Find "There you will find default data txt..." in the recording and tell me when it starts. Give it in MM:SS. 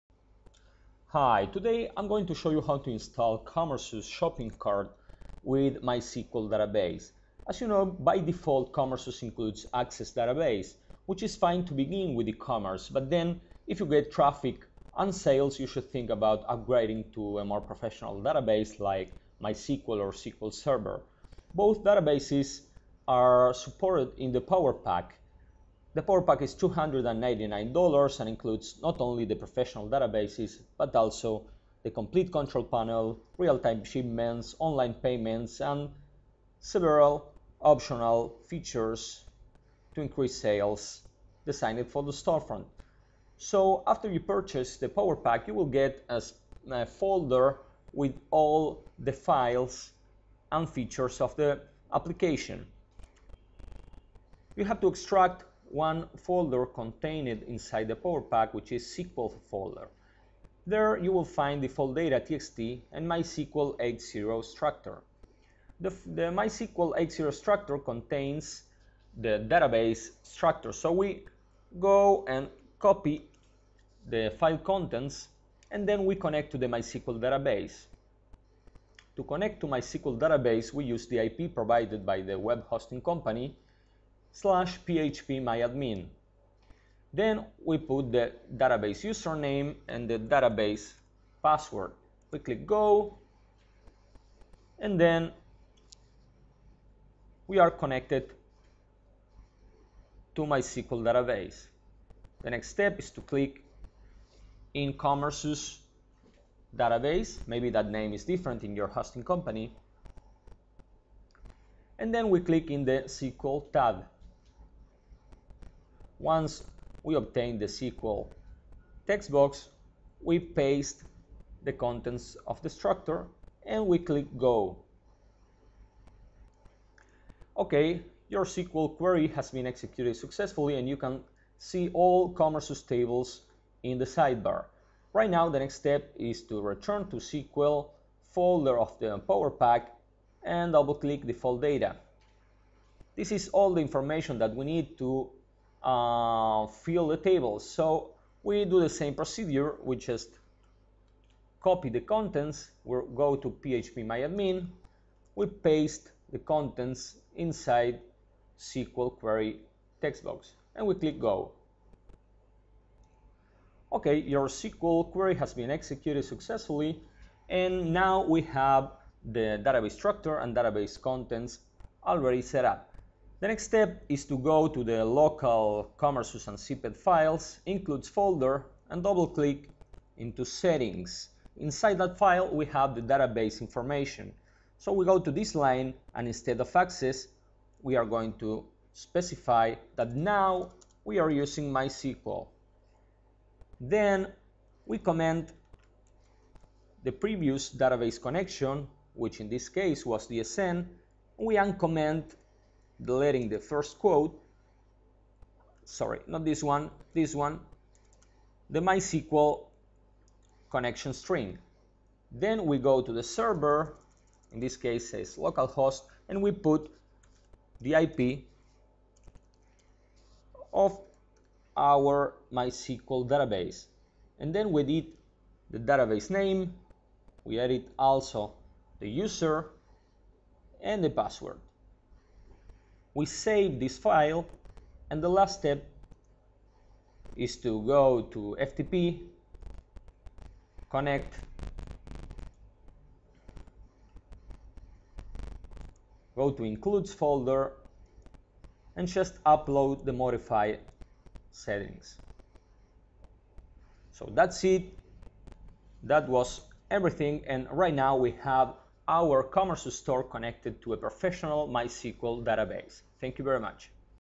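01:00.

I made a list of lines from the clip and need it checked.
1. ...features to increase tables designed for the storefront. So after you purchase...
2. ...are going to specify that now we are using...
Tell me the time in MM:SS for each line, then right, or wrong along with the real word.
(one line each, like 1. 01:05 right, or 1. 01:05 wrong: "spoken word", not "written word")
1. 00:38 wrong: "sales", not "tables"
2. 03:07 right.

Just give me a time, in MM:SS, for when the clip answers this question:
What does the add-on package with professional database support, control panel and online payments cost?
00:26.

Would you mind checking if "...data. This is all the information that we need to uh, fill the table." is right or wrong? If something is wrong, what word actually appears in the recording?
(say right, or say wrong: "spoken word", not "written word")
right.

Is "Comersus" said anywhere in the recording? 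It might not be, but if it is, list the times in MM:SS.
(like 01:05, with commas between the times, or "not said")
00:03, 01:44, 02:12, 02:55, 04:19.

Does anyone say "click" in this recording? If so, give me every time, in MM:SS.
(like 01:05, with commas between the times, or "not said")
01:32, 01:43, 01:52, 02:03, 02:20, 02:40, 02:59.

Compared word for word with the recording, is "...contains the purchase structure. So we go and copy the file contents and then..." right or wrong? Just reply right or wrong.
wrong.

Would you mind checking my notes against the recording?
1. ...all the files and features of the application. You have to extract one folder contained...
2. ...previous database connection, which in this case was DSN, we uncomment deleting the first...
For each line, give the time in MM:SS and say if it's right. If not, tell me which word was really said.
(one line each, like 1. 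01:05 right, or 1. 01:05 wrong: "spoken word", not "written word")
1. 00:48 right
2. 03:17 right.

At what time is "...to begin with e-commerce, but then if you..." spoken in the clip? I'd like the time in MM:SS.
00:11.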